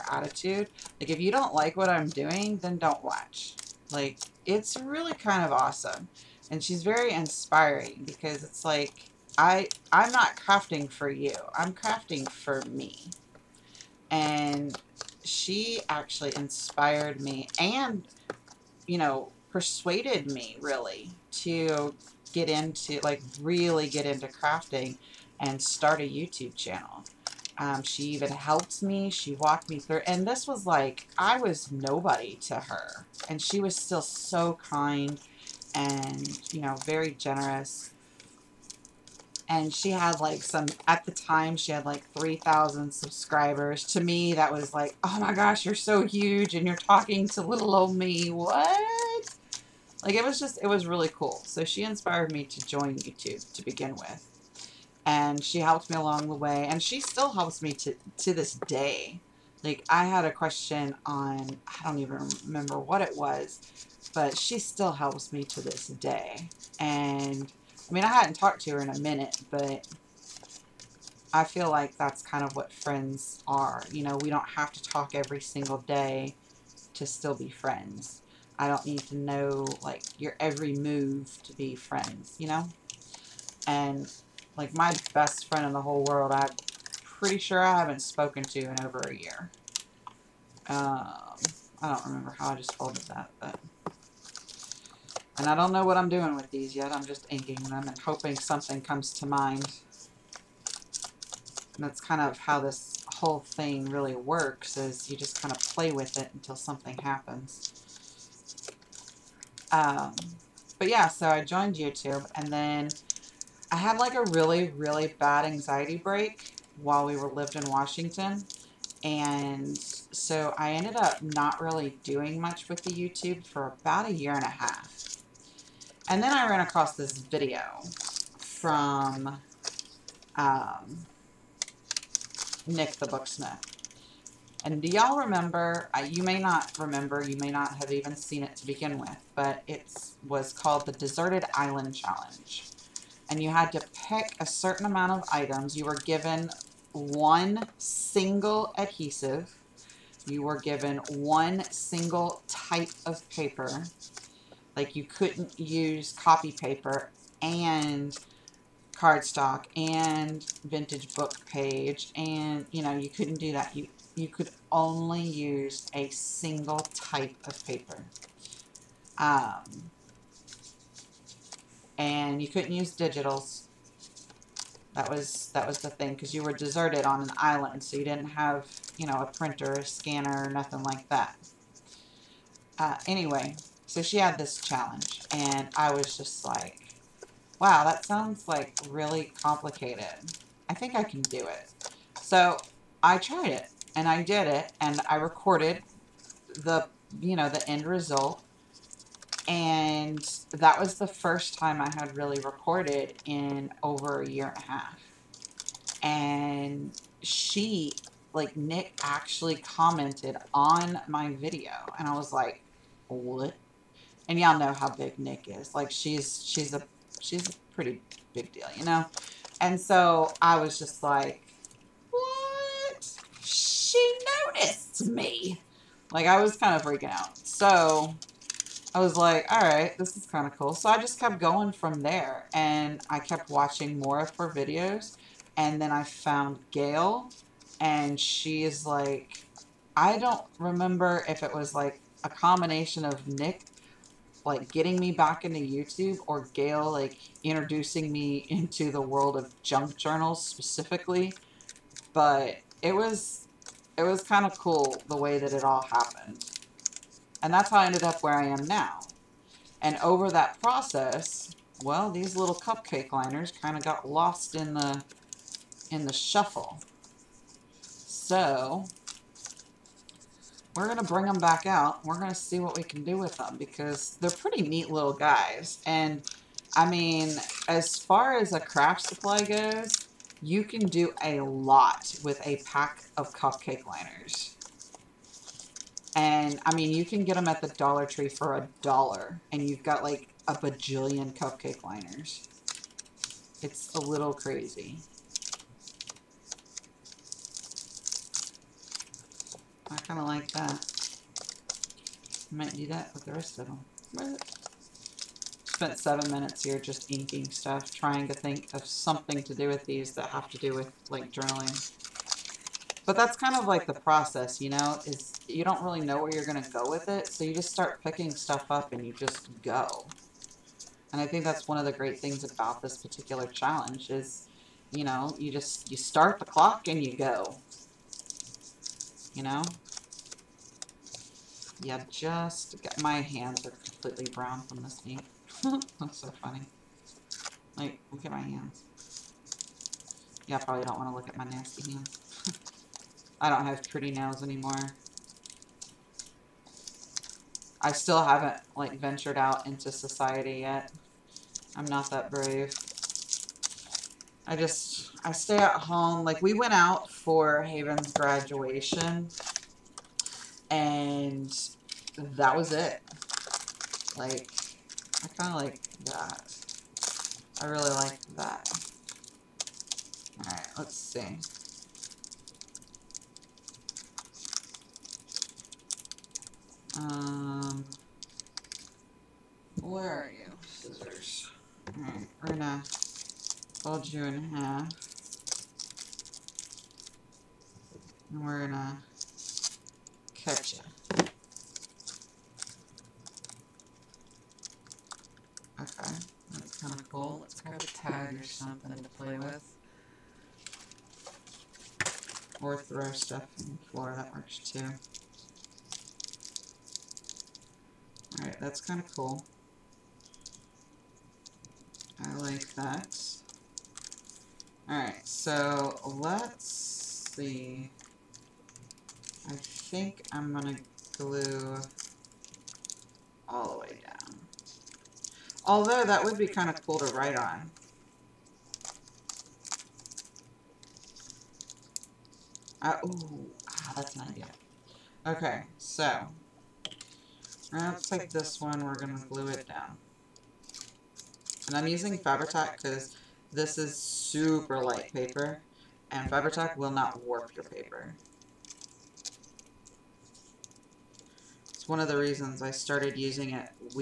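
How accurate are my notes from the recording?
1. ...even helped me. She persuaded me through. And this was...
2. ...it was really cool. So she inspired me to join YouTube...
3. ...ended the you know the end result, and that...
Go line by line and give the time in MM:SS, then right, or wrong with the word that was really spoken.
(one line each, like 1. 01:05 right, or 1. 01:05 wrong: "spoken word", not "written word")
1. 00:28 wrong: "walked", not "persuaded"
2. 00:50 right
3. 03:15 wrong: "recorded", not "ended".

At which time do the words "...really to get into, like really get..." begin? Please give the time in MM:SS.
00:20.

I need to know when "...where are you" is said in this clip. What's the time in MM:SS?
06:19.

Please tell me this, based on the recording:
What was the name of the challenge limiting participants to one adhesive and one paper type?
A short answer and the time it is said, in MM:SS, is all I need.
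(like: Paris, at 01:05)
Deserted Island Challenge, at 02:20.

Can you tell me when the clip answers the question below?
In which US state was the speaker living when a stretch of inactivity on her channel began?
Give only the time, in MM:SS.
01:57.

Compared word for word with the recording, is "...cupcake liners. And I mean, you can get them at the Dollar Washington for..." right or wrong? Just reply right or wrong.
wrong.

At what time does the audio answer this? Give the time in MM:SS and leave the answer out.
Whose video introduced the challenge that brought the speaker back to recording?
02:12.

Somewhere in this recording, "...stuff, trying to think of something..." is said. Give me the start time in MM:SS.
05:07.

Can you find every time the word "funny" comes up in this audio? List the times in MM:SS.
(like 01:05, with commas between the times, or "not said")
05:36.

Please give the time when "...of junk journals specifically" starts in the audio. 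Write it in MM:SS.
04:09.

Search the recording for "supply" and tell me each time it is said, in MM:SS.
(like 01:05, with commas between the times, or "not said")
04:39.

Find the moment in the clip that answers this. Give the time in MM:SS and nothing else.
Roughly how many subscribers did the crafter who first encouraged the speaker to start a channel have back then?
00:42.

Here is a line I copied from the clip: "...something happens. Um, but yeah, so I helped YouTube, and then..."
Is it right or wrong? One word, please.
wrong.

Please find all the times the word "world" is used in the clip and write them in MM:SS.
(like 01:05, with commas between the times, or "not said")
01:26, 04:09.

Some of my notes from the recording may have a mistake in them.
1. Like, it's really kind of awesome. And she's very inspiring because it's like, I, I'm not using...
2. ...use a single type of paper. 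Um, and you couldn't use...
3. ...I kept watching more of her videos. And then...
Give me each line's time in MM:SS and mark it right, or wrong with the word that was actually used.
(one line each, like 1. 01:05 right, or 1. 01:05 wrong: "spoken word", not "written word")
1. 00:03 wrong: "crafting", not "using"
2. 02:45 right
3. 03:53 right.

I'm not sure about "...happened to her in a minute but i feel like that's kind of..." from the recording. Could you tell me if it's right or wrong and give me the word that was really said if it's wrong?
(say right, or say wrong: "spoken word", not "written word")
wrong: "talked", not "happened".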